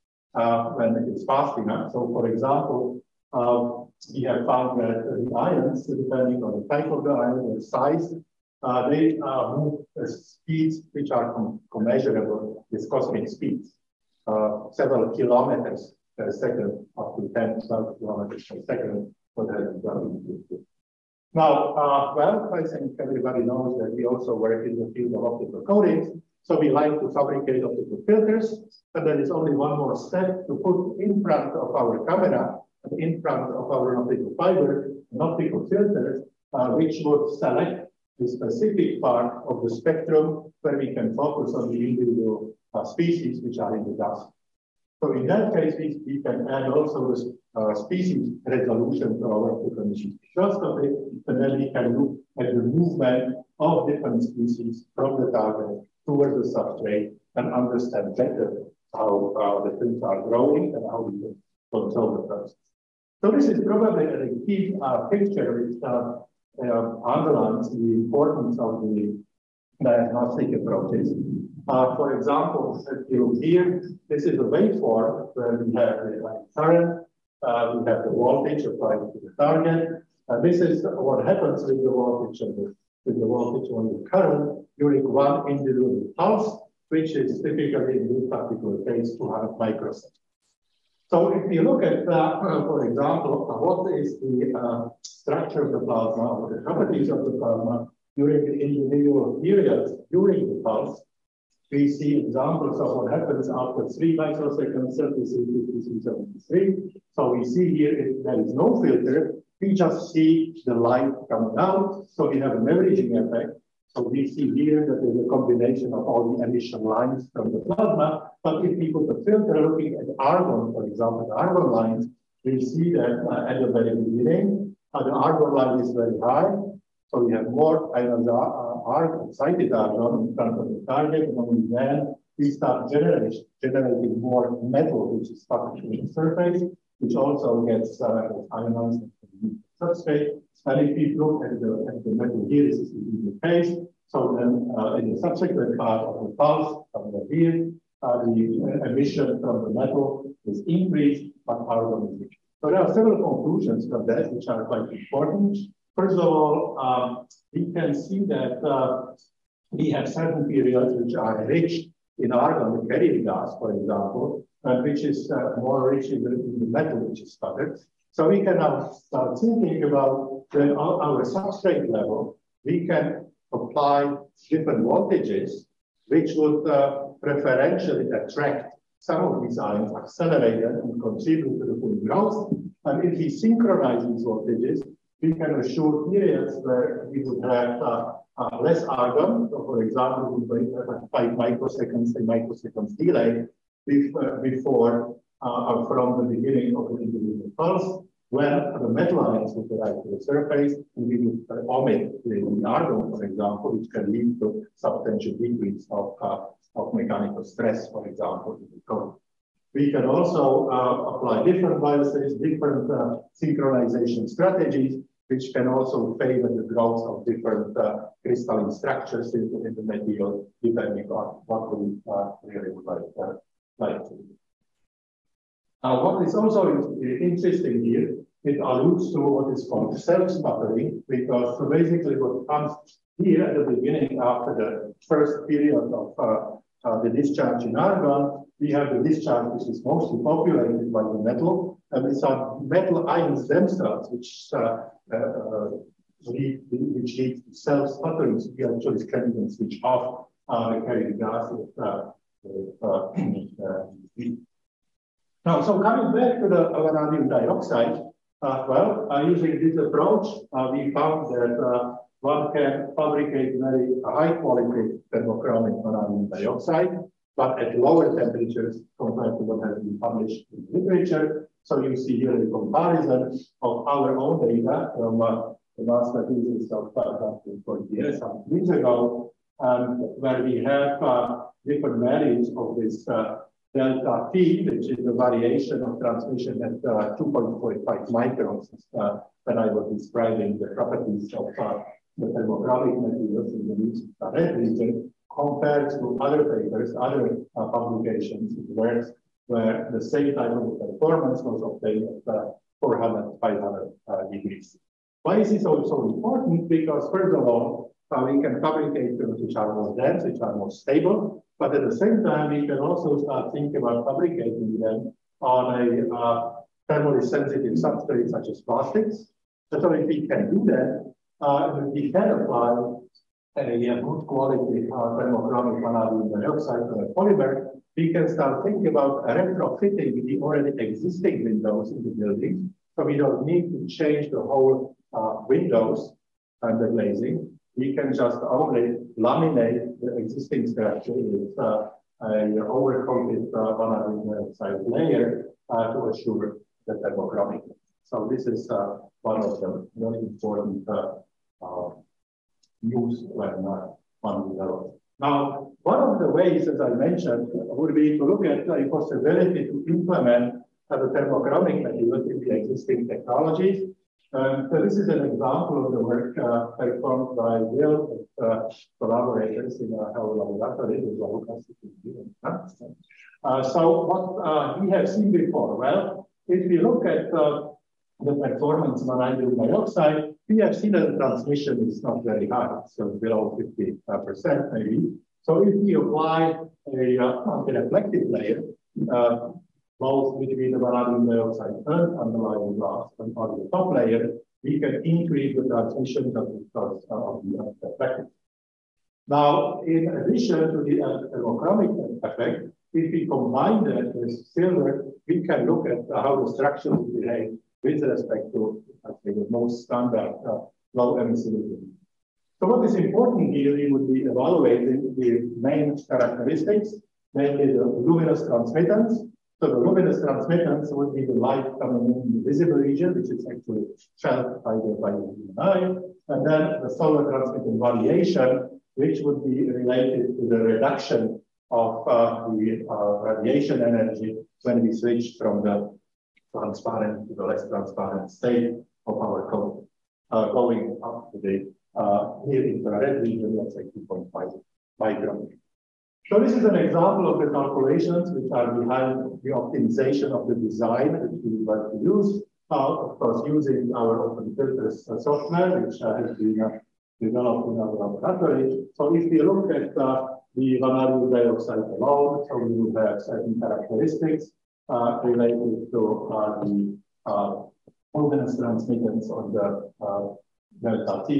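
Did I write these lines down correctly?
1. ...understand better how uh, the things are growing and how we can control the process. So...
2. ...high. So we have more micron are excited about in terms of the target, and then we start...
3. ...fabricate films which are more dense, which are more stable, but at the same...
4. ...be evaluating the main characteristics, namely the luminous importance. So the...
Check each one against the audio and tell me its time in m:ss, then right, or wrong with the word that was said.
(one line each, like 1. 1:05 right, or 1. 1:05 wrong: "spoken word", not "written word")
1. 0:57 right
2. 2:06 wrong: "ionization", not "micron"
3. 5:08 right
4. 6:54 wrong: "transmittance", not "importance".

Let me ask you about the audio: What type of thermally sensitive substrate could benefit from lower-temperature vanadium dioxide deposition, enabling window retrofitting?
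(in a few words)
plastics.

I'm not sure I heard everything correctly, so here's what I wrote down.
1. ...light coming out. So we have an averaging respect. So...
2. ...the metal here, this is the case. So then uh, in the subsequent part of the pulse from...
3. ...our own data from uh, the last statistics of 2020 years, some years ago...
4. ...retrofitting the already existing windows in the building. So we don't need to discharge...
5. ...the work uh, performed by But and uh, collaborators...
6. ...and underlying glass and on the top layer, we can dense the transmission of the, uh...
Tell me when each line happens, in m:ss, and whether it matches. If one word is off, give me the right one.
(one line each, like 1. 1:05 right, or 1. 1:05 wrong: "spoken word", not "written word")
1. 1:50 wrong: "effect", not "respect"
2. 2:22 right
3. 4:33 right
4. 5:29 wrong: "change", not "discharge"
5. 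6:05 wrong: "Will", not "But"
6. 6:31 wrong: "increase", not "dense".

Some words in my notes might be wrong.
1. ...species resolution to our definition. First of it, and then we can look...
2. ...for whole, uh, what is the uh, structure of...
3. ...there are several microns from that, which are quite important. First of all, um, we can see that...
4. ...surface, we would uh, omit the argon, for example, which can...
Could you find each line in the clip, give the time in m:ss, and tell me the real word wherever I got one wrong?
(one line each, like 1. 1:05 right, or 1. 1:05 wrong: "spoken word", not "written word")
1. 0:47 right
2. 1:32 wrong: "example", not "whole"
3. 2:32 wrong: "conclusions", not "microns"
4. 3:20 right.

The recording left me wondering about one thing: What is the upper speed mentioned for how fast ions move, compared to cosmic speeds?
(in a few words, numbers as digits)
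12 kilometers per second.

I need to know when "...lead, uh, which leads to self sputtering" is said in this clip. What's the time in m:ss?
4:06.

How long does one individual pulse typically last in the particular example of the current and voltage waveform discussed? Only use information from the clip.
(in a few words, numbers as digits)
200 microseconds.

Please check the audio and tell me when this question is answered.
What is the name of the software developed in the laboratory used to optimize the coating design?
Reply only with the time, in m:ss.
7:34.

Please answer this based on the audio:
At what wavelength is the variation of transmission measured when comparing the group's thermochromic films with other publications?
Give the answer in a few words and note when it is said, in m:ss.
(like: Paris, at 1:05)
2.45 microns, at 4:47.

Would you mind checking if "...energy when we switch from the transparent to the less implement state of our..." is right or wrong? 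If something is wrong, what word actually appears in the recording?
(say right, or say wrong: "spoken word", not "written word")
wrong: "transparent", not "implement".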